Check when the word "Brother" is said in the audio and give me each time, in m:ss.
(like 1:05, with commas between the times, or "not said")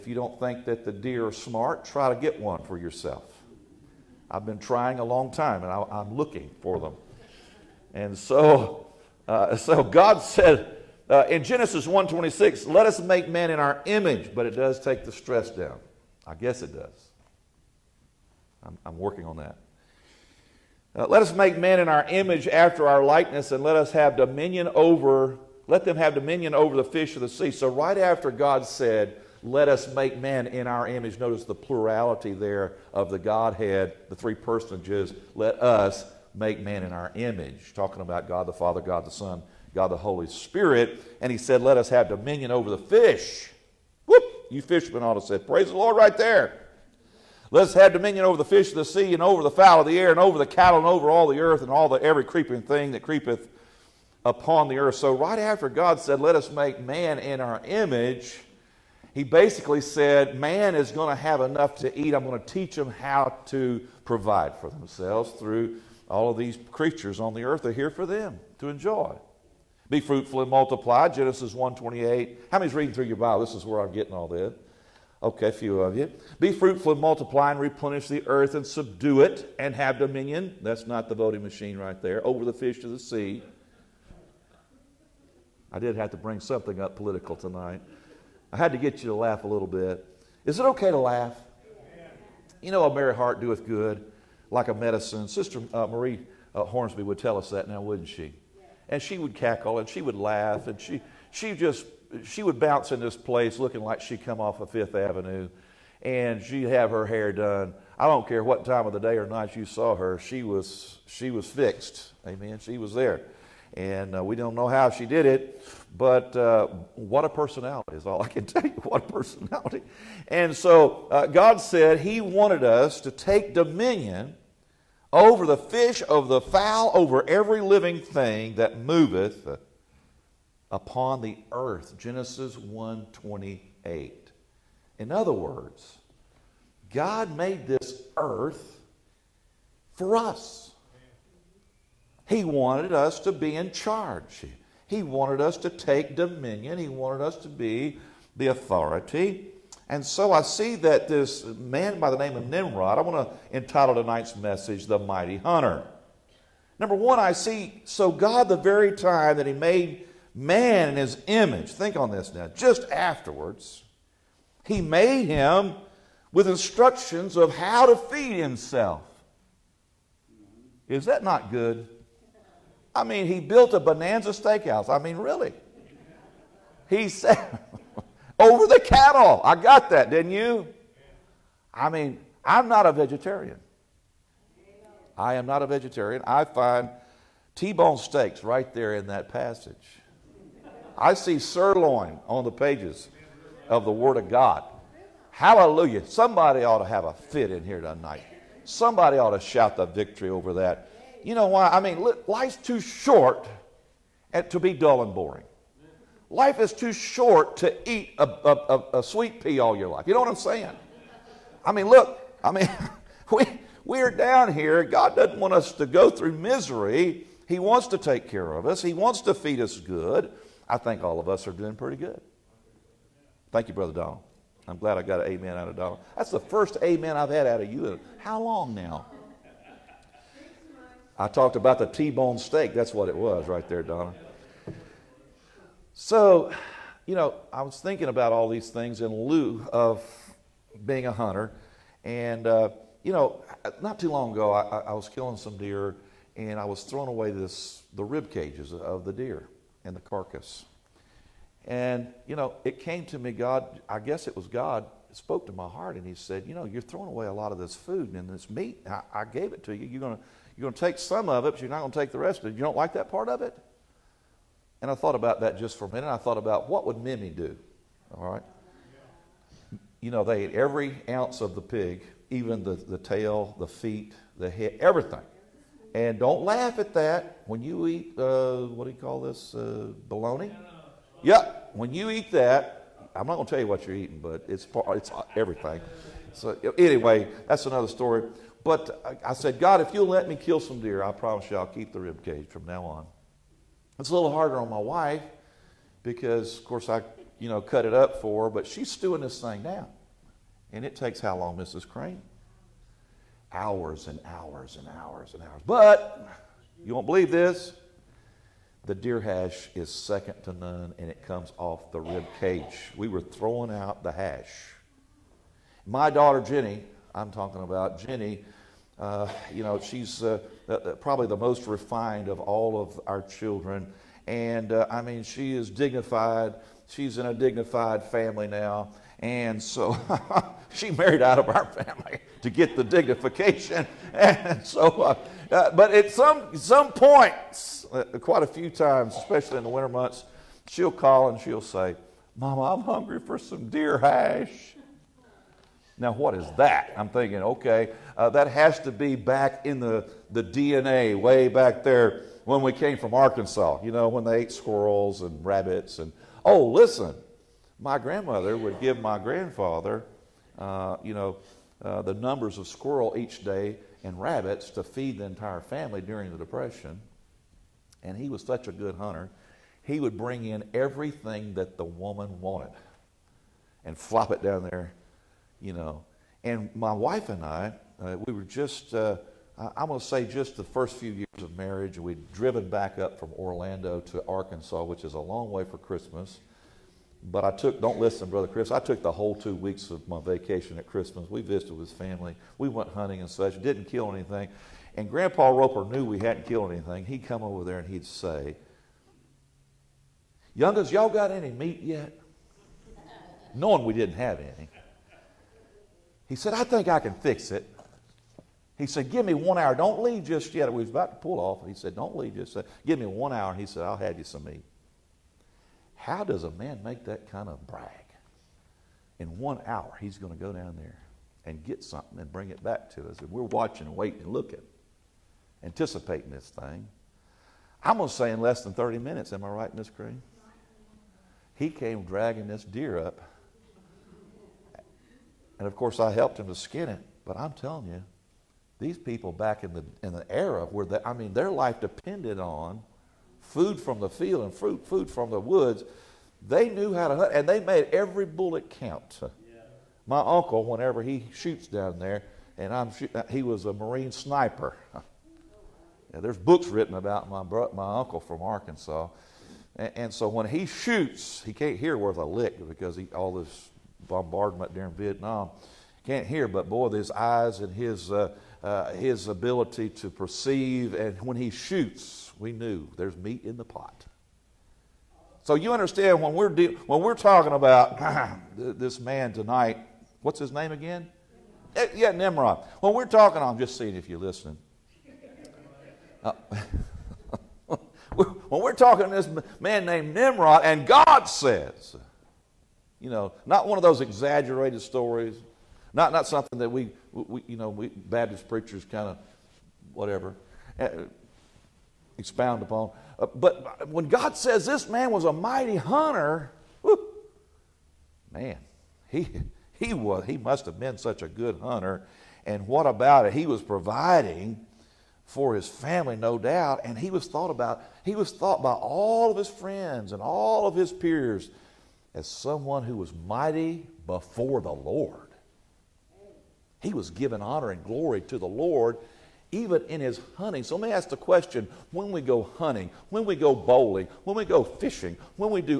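3:43, 6:28.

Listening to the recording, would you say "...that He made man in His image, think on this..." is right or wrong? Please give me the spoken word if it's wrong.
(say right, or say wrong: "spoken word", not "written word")
right.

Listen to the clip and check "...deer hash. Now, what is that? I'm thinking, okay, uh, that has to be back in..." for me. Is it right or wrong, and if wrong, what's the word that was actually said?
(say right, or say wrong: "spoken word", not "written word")
right.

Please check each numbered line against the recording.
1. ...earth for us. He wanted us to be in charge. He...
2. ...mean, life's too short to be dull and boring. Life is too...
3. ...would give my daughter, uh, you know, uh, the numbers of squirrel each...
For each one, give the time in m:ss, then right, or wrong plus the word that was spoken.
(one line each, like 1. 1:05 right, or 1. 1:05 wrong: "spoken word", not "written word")
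1. 2:18 right
2. 3:21 right
3. 5:58 wrong: "grandfather", not "daughter".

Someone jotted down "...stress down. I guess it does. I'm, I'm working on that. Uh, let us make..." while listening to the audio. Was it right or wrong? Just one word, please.
right.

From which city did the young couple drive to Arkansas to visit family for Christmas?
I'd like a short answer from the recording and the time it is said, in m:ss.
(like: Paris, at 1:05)
Orlando, at 6:23.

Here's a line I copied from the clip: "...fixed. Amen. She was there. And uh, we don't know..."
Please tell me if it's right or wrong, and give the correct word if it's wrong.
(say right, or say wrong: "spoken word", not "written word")
right.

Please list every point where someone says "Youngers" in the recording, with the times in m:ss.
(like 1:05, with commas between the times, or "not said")
6:40.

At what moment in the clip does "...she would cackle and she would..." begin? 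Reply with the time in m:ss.
1:39.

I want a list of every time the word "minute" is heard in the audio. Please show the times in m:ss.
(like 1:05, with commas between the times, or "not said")
4:25, 7:08.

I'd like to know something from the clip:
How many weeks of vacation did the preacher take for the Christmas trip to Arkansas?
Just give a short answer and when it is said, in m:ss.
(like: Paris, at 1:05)
2, at 6:29.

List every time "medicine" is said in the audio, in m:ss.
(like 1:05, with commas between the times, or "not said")
1:34.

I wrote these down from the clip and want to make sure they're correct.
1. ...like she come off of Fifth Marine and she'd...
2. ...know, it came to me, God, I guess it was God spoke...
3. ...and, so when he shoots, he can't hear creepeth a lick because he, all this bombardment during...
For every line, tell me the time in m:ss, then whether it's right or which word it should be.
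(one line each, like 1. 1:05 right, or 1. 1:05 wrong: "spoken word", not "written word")
1. 1:43 wrong: "Avenue", not "Marine"
2. 4:12 right
3. 7:39 wrong: "worth", not "creepeth".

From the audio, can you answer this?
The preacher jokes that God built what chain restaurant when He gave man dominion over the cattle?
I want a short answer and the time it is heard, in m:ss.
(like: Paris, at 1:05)
Bonanza steakhouse, at 2:53.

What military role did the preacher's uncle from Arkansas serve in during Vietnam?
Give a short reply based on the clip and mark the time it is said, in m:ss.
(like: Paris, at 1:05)
Marine sniper, at 7:33.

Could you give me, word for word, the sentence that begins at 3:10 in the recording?
I see sirloin on the pages of the Word of God.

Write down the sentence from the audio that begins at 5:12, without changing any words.
We were throwing out the hash.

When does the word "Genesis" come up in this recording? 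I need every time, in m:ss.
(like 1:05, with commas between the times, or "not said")
0:11, 1:11, 2:11.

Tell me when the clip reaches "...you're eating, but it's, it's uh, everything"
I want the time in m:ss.
4:43.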